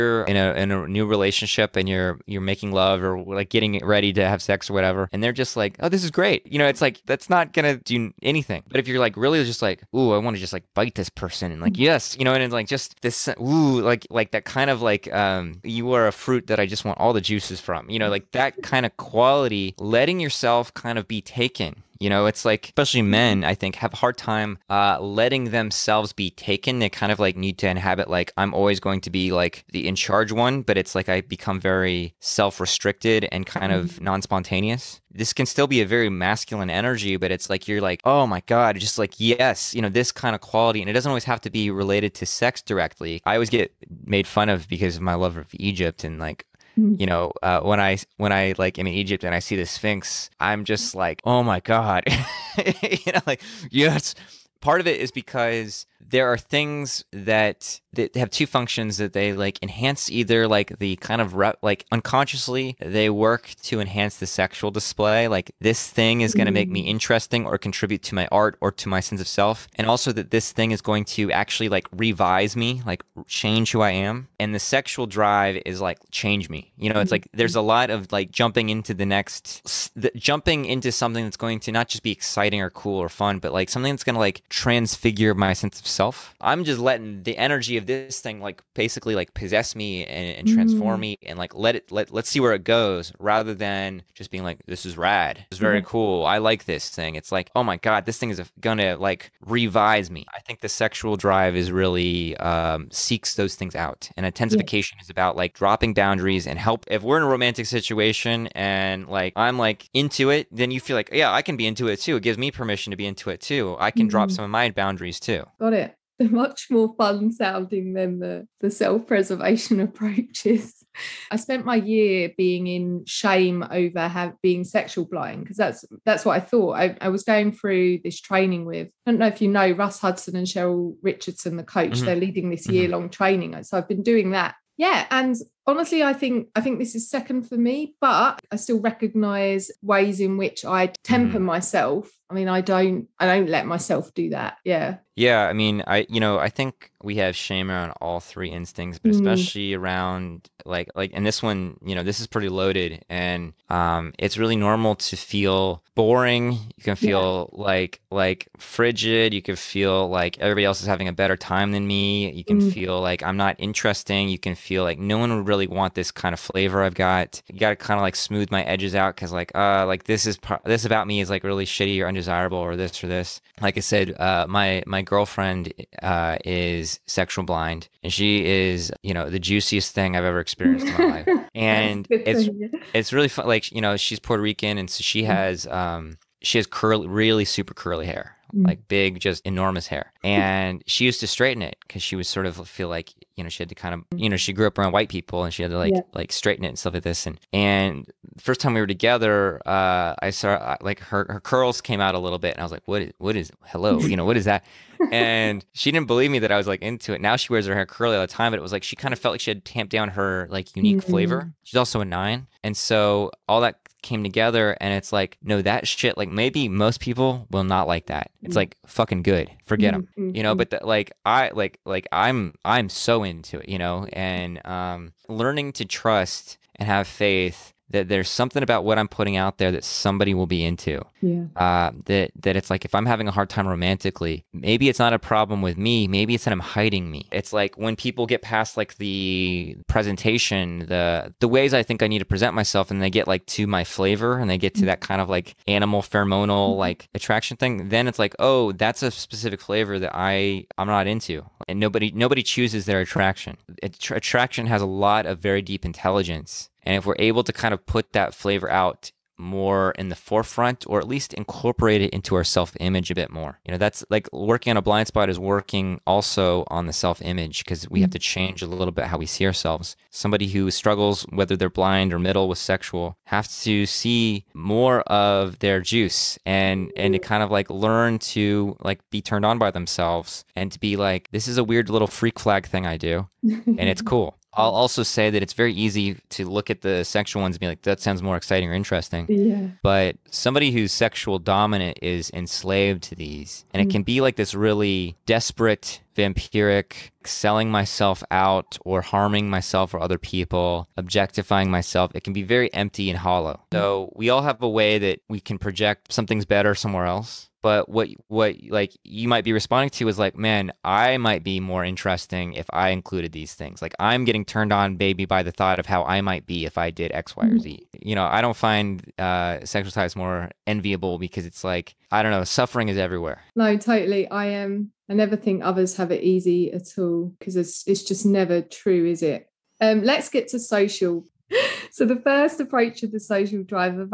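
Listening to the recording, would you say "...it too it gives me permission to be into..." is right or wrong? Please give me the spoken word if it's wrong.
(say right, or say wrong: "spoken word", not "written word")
right.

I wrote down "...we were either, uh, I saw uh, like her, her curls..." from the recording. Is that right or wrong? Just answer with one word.
wrong.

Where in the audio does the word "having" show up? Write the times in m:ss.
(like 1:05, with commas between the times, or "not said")
2:40, 3:53.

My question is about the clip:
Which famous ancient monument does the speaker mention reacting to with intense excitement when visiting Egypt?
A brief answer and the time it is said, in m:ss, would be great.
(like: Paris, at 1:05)
The Sphinx, at 0:49.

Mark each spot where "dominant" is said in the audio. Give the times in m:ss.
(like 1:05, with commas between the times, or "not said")
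4:51.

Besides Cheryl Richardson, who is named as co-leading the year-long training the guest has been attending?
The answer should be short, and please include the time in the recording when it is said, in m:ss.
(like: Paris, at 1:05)
Russ Hudson, at 2:09.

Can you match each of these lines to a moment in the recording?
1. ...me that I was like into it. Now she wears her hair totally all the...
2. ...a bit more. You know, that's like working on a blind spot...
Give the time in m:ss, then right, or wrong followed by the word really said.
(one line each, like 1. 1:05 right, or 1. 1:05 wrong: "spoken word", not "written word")
1. 3:26 wrong: "curly", not "totally"
2. 4:23 right.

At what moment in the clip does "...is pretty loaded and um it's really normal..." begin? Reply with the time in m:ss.
2:32.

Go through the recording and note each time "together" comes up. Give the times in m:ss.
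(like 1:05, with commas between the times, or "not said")
3:18, 3:34.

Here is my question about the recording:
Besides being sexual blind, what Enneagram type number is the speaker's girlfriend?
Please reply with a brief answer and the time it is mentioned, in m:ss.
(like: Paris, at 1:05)
9, at 3:32.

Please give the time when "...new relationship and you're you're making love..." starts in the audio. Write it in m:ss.
0:00.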